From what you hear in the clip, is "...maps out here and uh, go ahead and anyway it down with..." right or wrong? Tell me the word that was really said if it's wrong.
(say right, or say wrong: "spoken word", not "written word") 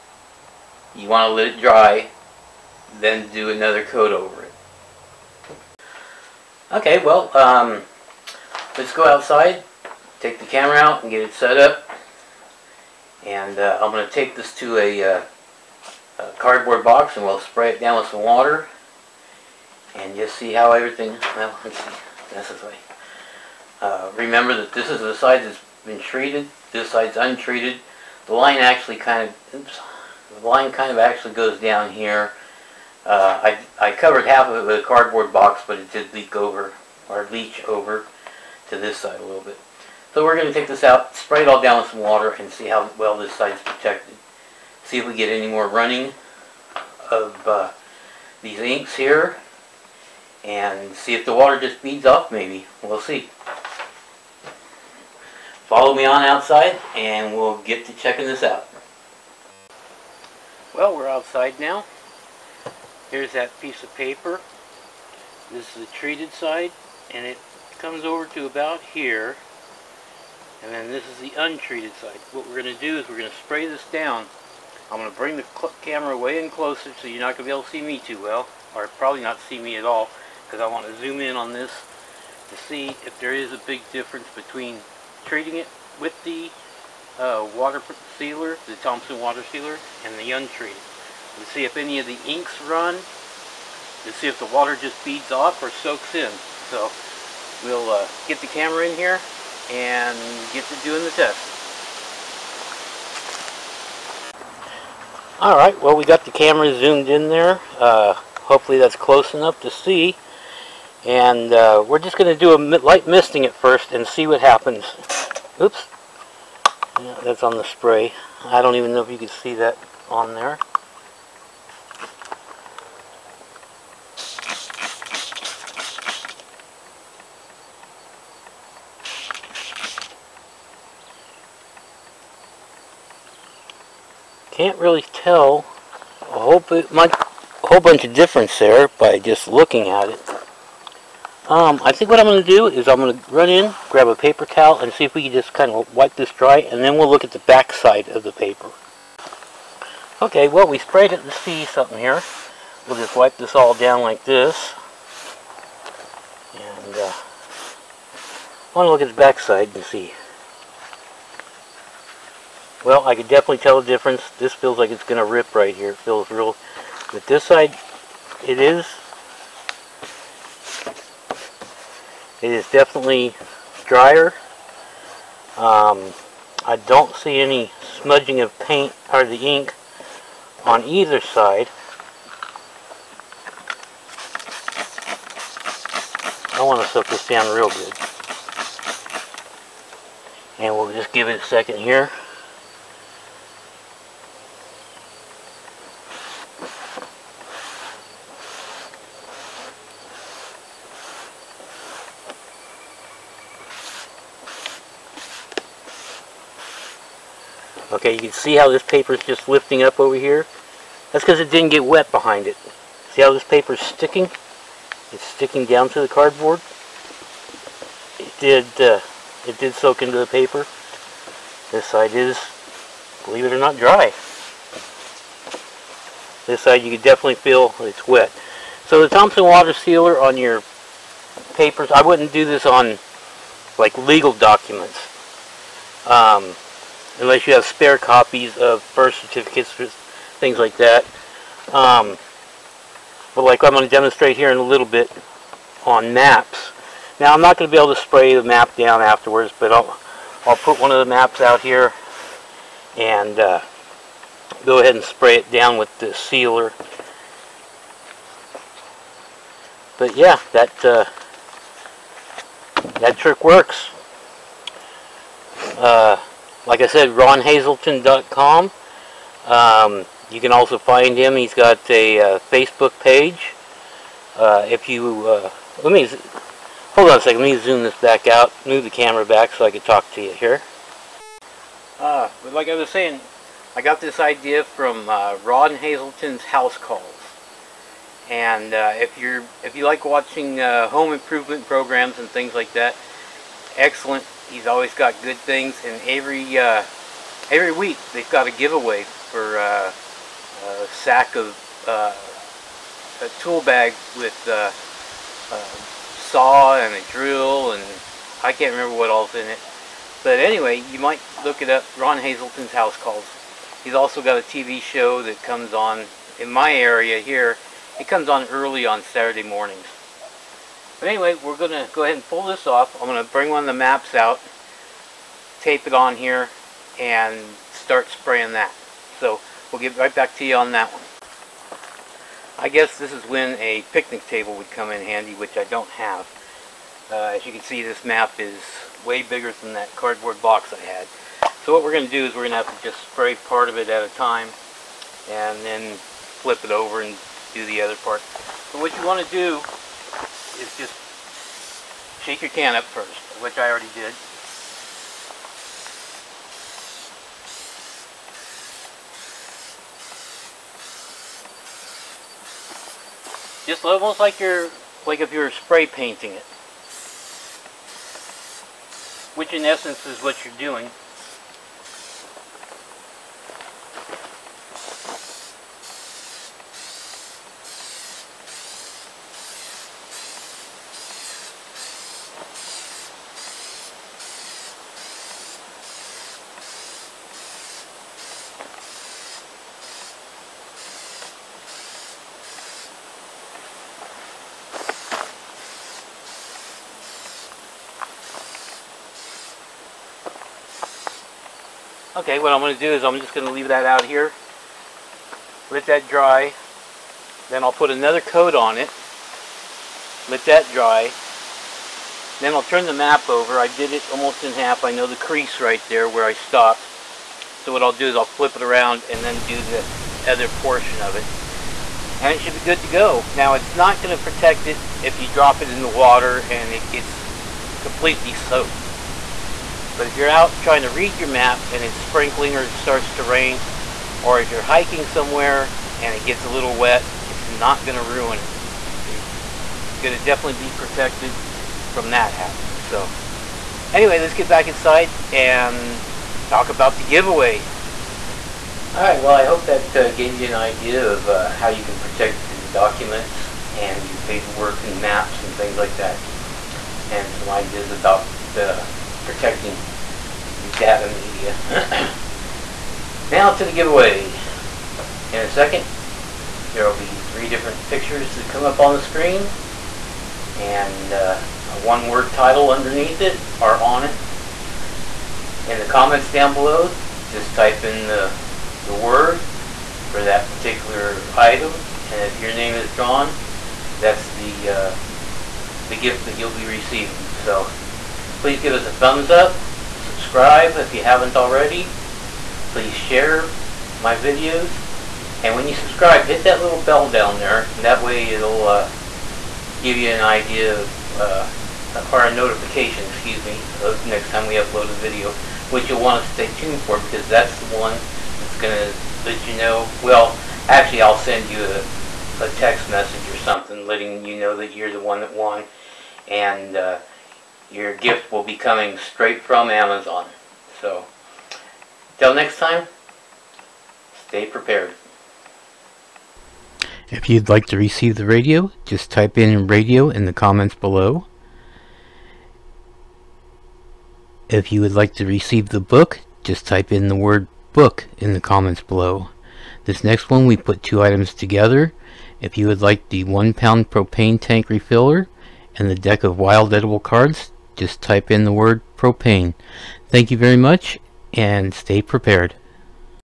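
wrong: "spray", not "anyway".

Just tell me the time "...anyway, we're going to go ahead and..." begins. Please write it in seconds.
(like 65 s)
321 s.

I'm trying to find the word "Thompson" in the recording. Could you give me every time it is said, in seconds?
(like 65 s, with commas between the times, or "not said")
88 s, 229 s.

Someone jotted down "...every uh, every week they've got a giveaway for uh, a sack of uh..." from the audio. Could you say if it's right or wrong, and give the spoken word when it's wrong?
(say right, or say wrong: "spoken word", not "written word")
right.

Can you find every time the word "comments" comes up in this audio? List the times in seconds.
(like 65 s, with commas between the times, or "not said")
475 s, 530 s, 538 s.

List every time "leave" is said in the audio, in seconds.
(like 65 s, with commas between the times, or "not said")
403 s.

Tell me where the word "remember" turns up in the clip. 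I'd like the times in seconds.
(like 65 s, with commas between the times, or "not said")
24 s, 308 s.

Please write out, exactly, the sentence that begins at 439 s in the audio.
You're going to definitely be protected from that happening.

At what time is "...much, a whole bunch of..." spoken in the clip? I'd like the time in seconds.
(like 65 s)
136 s.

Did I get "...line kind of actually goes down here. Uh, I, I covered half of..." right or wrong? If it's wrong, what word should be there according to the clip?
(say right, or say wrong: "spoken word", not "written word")
right.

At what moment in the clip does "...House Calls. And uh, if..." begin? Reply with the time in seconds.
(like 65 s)
286 s.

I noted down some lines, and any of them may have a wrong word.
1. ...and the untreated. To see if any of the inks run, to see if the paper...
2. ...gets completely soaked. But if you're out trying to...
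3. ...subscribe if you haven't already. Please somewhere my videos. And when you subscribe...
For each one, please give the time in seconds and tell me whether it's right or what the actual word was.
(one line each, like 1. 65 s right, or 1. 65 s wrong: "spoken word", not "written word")
1. 90 s wrong: "water", not "paper"
2. 426 s right
3. 490 s wrong: "share", not "somewhere".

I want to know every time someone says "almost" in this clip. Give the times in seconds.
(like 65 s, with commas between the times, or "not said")
363 s, 414 s.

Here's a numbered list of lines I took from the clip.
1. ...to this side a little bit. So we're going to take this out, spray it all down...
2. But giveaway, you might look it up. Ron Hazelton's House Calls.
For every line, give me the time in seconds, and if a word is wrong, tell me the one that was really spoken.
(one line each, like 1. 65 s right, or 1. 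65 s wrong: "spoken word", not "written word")
1. 38 s right
2. 310 s wrong: "anyway", not "giveaway".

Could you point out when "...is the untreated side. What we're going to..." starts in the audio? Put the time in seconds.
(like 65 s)
71 s.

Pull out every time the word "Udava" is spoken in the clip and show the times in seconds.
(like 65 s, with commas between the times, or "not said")
460 s.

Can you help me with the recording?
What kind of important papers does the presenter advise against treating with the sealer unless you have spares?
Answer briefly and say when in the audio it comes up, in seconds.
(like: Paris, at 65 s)
Legal documents, at 233 s.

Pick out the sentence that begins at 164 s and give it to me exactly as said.
This feels like it's going to rip right here.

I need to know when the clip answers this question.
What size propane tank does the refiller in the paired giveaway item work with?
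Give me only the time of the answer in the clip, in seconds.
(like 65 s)
543 s.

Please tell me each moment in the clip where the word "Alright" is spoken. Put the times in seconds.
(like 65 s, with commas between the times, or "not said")
105 s, 448 s.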